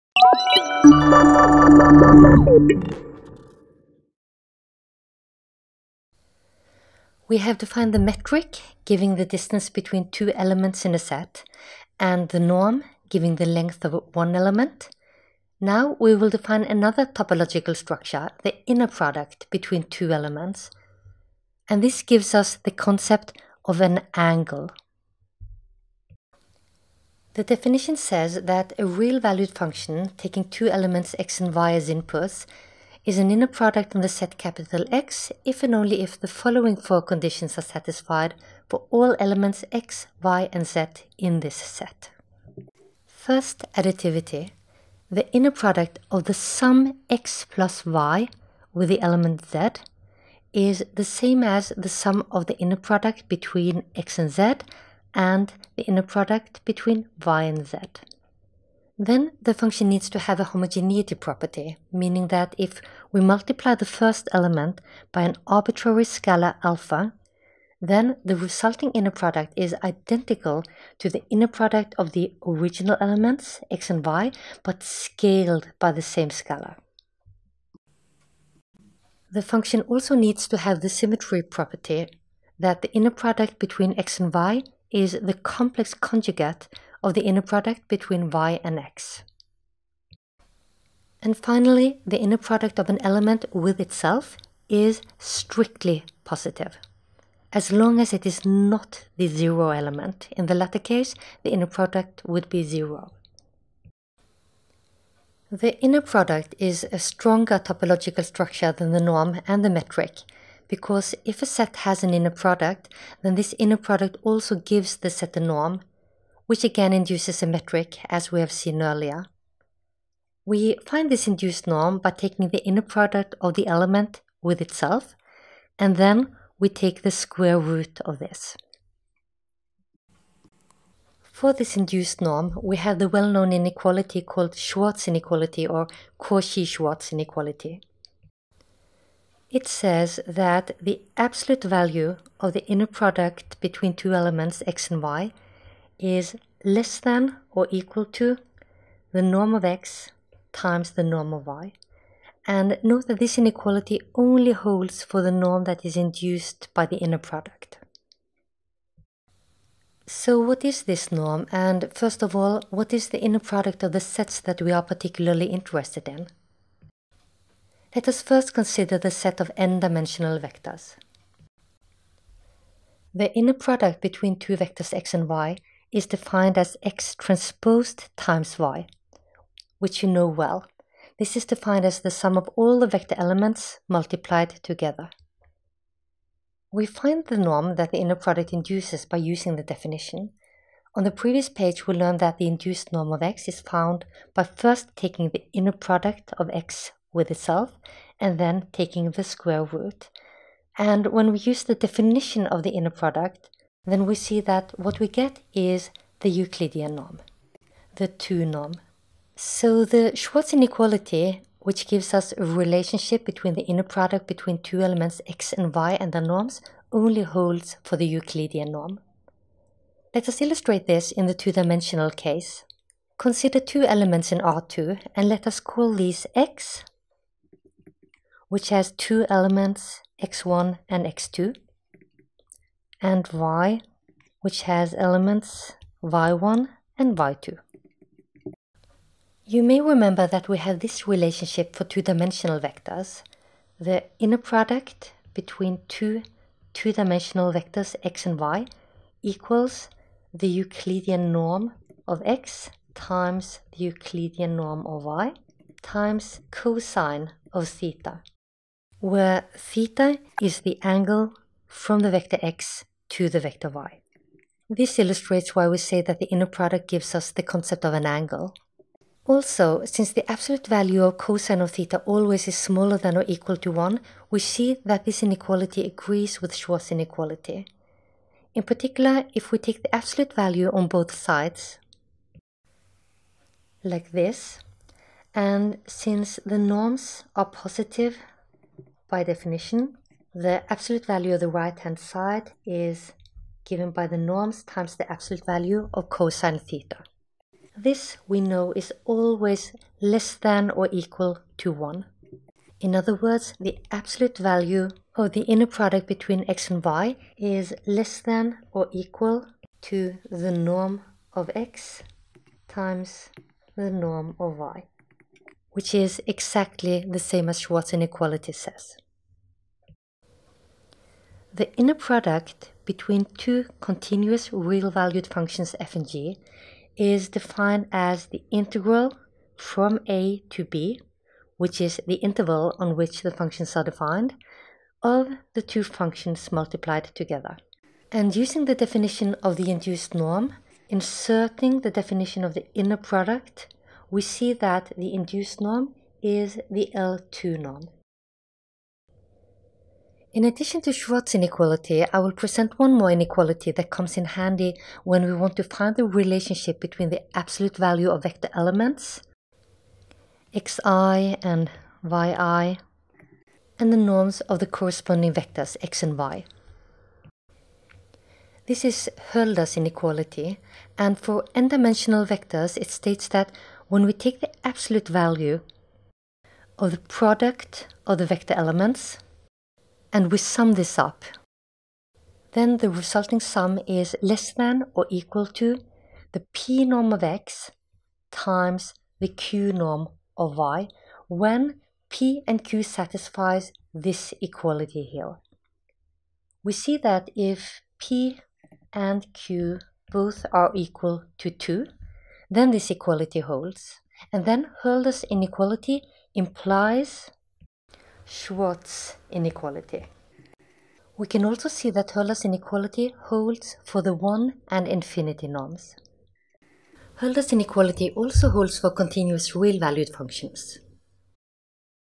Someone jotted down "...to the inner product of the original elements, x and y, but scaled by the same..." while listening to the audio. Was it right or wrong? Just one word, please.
right.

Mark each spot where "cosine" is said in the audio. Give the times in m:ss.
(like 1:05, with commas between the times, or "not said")
4:16, 4:31, 4:56.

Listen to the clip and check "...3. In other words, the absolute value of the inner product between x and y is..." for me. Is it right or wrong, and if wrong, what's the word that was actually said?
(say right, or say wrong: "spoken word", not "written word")
wrong: "1", not "3".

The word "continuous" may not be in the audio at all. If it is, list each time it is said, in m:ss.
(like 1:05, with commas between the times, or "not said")
5:23, 6:58.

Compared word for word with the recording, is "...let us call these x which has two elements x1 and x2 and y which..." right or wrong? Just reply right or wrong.
right.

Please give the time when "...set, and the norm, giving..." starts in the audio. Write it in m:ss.
0:10.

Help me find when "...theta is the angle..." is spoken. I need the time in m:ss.
4:19.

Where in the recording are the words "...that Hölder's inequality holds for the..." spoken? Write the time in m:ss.
6:51.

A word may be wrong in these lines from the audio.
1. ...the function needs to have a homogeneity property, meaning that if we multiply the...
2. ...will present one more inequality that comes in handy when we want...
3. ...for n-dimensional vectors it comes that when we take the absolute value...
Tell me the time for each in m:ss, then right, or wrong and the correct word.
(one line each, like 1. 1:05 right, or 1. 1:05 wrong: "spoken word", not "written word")
1. 0:59 right
2. 5:52 right
3. 6:11 wrong: "states", not "comes".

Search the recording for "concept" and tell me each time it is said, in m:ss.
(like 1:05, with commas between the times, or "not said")
0:22, 4:27.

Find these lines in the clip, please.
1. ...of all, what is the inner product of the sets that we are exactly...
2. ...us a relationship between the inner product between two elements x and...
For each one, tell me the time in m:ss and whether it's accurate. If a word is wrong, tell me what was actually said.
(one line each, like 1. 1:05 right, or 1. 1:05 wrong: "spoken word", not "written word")
1. 2:42 wrong: "particularly", not "exactly"
2. 3:32 right.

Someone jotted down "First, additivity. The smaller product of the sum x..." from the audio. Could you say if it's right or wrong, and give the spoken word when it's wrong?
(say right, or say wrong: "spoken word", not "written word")
wrong: "inner", not "smaller".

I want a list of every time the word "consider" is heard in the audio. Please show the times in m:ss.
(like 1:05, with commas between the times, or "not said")
2:48, 3:43.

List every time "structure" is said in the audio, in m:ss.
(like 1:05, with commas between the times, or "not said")
0:17, 1:48.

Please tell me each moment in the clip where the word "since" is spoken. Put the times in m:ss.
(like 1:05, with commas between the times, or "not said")
4:29, 4:45.